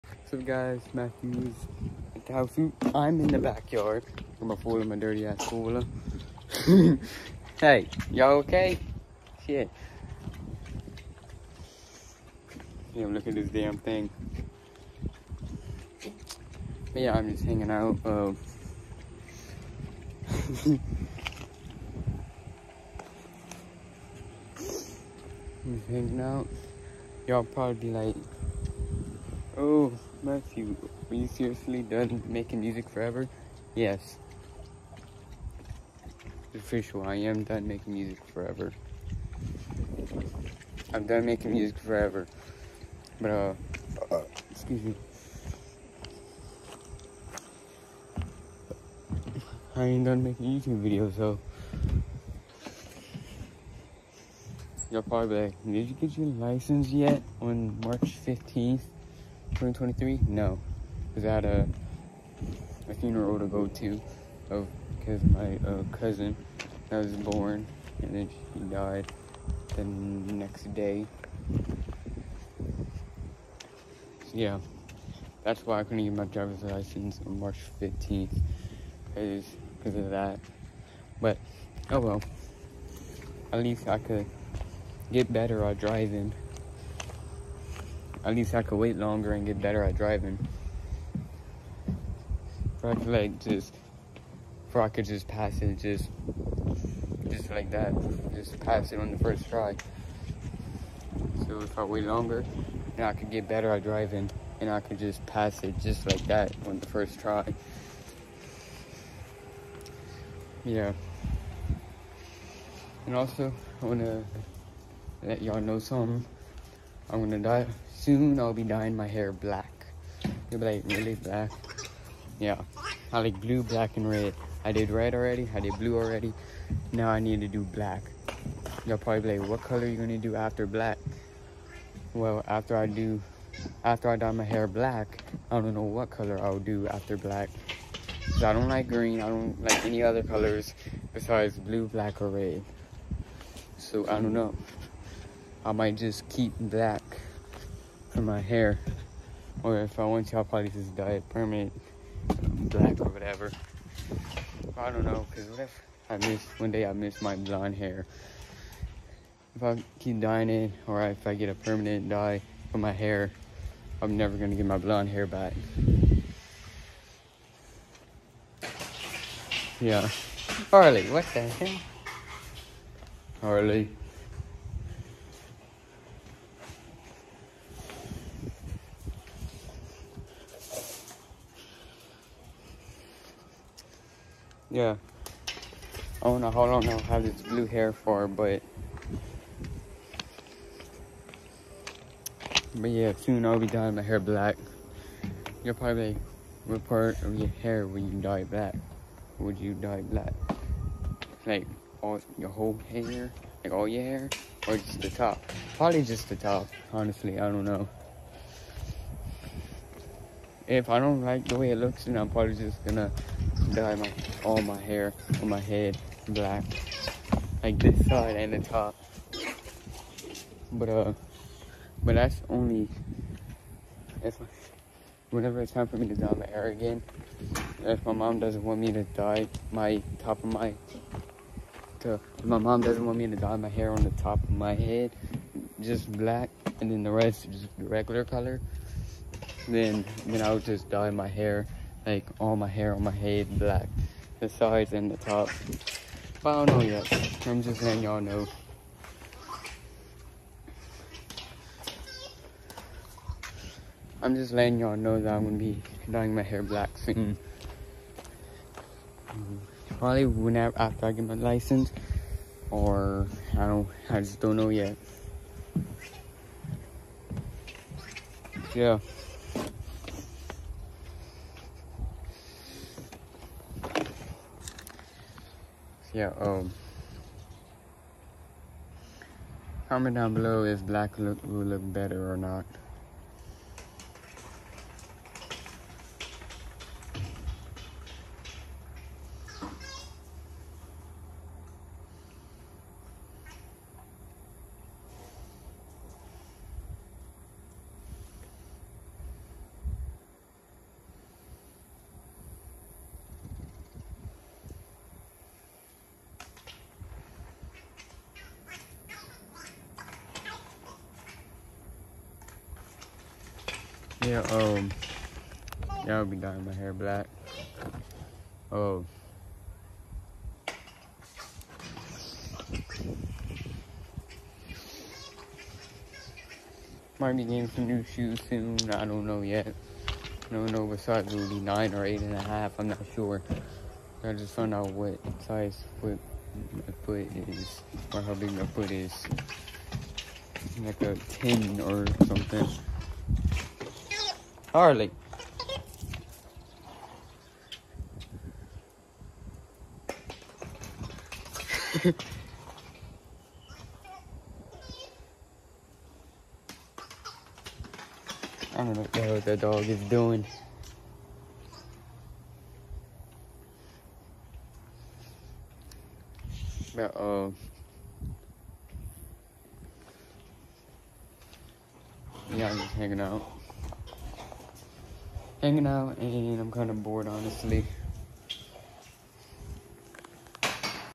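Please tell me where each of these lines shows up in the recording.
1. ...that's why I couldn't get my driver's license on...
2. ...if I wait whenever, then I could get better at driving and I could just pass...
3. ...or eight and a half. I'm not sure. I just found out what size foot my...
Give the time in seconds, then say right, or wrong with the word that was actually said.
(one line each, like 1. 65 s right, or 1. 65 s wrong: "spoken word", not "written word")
1. 75 s right
2. 101 s wrong: "longer", not "whenever"
3. 331 s right.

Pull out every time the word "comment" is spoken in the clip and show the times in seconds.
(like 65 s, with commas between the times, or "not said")
279 s.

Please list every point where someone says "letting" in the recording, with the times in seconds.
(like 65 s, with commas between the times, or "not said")
247 s, 254 s.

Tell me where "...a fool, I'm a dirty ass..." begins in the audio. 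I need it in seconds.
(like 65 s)
4 s.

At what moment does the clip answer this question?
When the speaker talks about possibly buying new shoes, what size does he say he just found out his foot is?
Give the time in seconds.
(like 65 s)
341 s.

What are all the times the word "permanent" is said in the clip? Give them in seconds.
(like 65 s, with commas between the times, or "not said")
151 s, 161 s.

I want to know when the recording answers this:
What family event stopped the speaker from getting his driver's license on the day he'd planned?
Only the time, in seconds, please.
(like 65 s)
62 s.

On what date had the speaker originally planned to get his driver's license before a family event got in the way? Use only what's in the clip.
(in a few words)
March 15th, 2023.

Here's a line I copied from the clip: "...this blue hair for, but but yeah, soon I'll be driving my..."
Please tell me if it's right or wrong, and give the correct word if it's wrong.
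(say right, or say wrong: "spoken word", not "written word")
wrong: "dyeing", not "driving".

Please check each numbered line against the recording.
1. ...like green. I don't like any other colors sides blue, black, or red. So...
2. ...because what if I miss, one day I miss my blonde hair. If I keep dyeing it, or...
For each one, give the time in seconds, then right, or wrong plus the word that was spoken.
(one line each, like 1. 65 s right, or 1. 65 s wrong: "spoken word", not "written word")
1. 138 s wrong: "besides", not "sides"
2. 155 s right.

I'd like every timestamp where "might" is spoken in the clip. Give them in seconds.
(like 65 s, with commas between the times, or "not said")
145 s, 327 s.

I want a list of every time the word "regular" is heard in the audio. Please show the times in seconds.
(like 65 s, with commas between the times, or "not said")
237 s.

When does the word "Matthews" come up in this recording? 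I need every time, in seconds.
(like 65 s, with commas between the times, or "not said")
0 s, 30 s.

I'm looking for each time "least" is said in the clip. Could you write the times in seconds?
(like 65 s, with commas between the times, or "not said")
83 s, 88 s.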